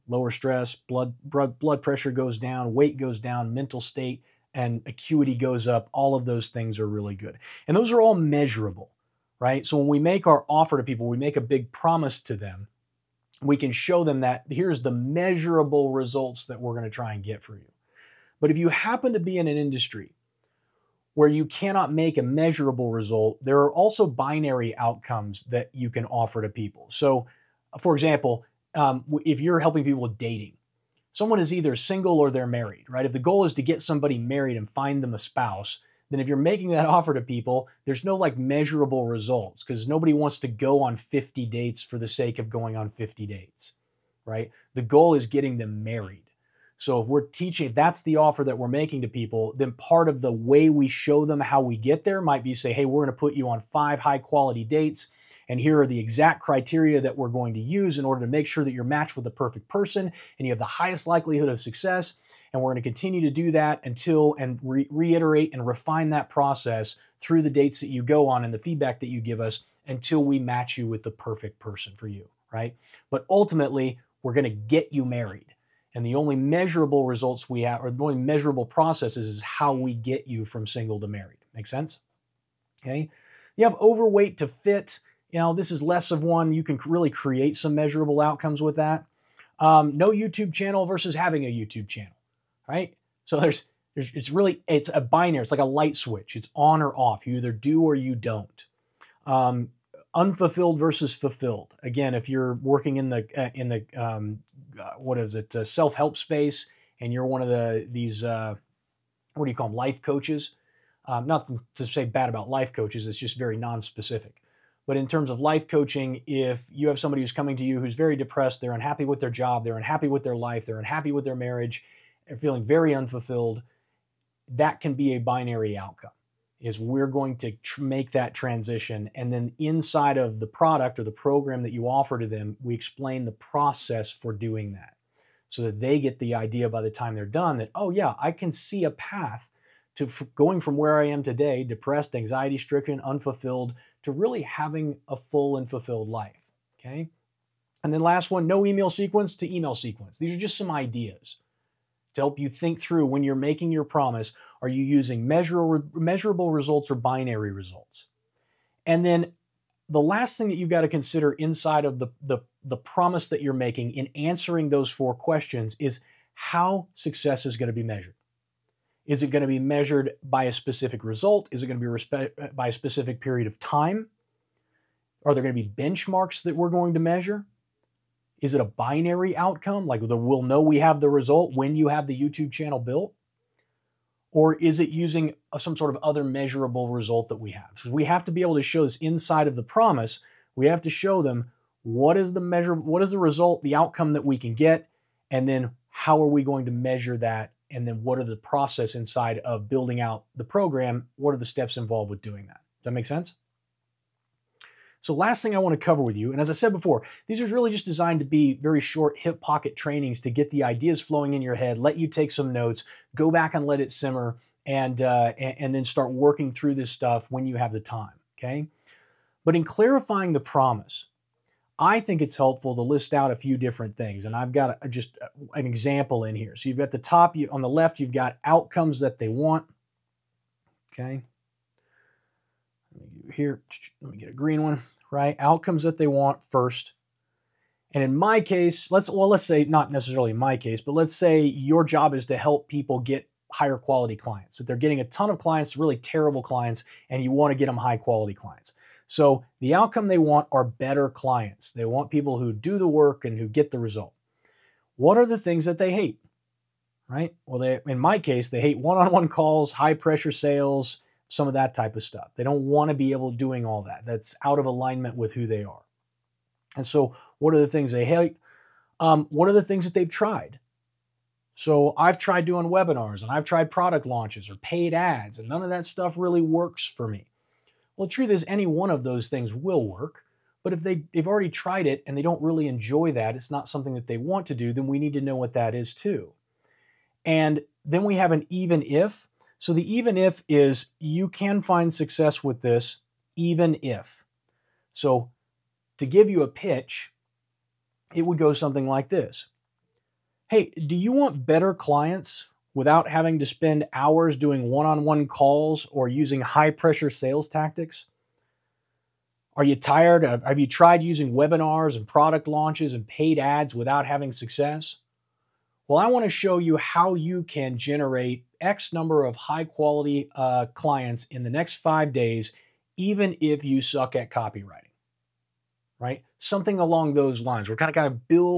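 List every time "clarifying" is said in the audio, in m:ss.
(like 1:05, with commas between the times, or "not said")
3:39.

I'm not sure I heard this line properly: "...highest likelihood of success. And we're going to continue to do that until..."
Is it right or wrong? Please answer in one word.
right.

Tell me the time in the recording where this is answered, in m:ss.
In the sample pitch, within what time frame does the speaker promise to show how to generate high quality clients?
5:21.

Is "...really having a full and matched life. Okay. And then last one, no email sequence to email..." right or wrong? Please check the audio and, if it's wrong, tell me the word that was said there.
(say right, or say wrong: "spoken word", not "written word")
wrong: "fulfilled", not "matched".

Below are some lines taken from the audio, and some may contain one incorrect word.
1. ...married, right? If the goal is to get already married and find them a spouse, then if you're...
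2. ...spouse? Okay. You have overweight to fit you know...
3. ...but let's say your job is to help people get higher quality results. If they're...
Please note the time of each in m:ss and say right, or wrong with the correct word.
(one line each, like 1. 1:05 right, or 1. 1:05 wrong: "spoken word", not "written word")
1. 0:32 wrong: "somebody", not "already"
2. 1:21 wrong: "sense", not "spouse"
3. 4:00 wrong: "clients", not "results".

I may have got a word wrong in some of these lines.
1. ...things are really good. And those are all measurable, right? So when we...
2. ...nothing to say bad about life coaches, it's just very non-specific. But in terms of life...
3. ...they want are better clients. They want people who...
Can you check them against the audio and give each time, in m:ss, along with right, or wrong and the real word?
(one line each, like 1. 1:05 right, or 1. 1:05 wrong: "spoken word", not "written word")
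1. 0:06 right
2. 1:51 right
3. 4:10 right.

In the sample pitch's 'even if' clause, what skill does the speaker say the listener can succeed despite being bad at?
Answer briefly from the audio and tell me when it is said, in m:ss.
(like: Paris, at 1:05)
Copywriting, at 5:24.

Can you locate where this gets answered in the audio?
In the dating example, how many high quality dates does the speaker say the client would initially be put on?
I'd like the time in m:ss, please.
0:53.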